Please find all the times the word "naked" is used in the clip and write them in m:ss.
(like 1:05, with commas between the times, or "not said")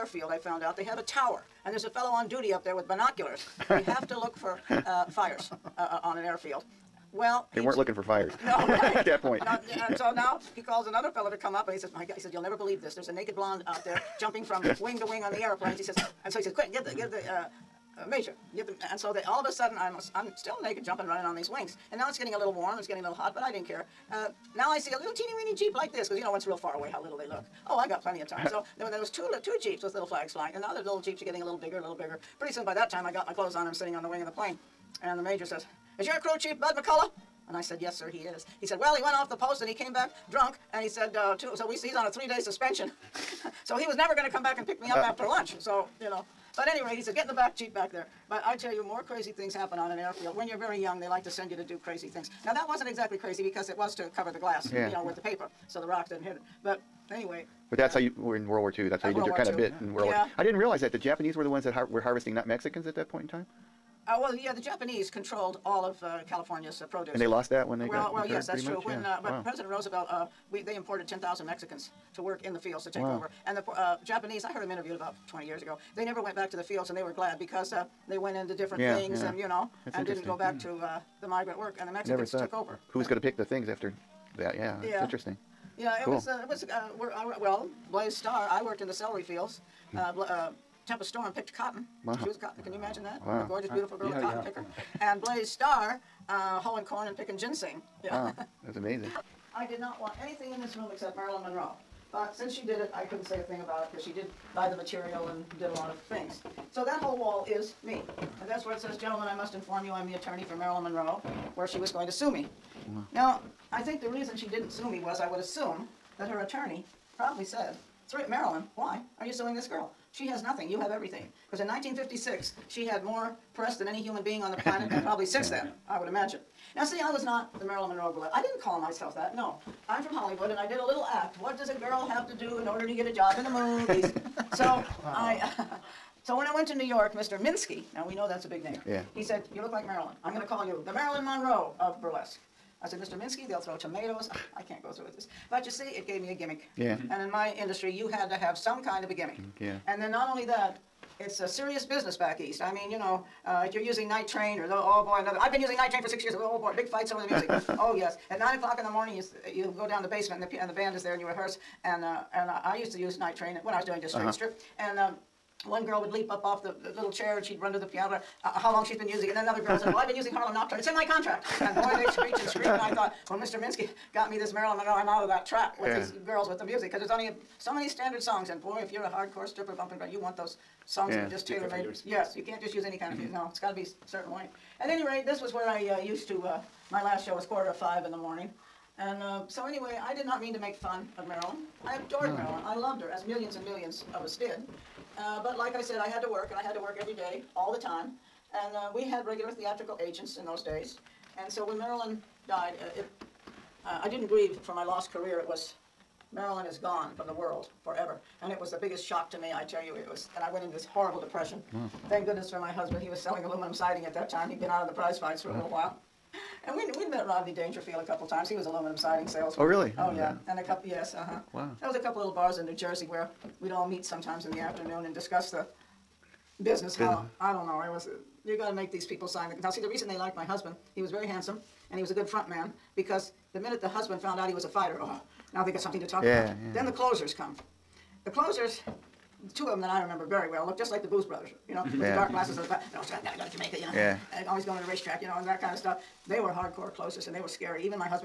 0:13, 0:20.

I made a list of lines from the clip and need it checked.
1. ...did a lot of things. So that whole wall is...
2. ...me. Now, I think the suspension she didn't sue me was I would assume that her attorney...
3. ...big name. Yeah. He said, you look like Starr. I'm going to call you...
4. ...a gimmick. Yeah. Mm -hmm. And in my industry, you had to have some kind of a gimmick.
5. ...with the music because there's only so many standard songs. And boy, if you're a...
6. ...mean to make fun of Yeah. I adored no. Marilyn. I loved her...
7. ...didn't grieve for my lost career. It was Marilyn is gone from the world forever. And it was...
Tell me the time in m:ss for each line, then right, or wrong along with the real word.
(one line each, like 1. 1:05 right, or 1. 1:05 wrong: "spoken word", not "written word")
1. 1:45 right
2. 1:52 wrong: "reason", not "suspension"
3. 2:18 wrong: "Marilyn", not "Starr"
4. 2:26 right
5. 2:56 right
6. 3:10 wrong: "Marilyn", not "Yeah"
7. 3:24 right.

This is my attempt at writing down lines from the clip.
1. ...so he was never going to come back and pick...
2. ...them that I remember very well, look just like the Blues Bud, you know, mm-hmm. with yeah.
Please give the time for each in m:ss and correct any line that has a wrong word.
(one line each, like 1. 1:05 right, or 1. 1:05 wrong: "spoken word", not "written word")
1. 0:43 right
2. 3:59 wrong: "Brothers", not "Bud".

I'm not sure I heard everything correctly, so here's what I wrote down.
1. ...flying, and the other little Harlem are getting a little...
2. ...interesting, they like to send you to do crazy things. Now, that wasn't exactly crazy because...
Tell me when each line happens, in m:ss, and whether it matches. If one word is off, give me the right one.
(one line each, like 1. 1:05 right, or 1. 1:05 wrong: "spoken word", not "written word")
1. 0:30 wrong: "Jeeps", not "Harlem"
2. 0:50 wrong: "young", not "interesting".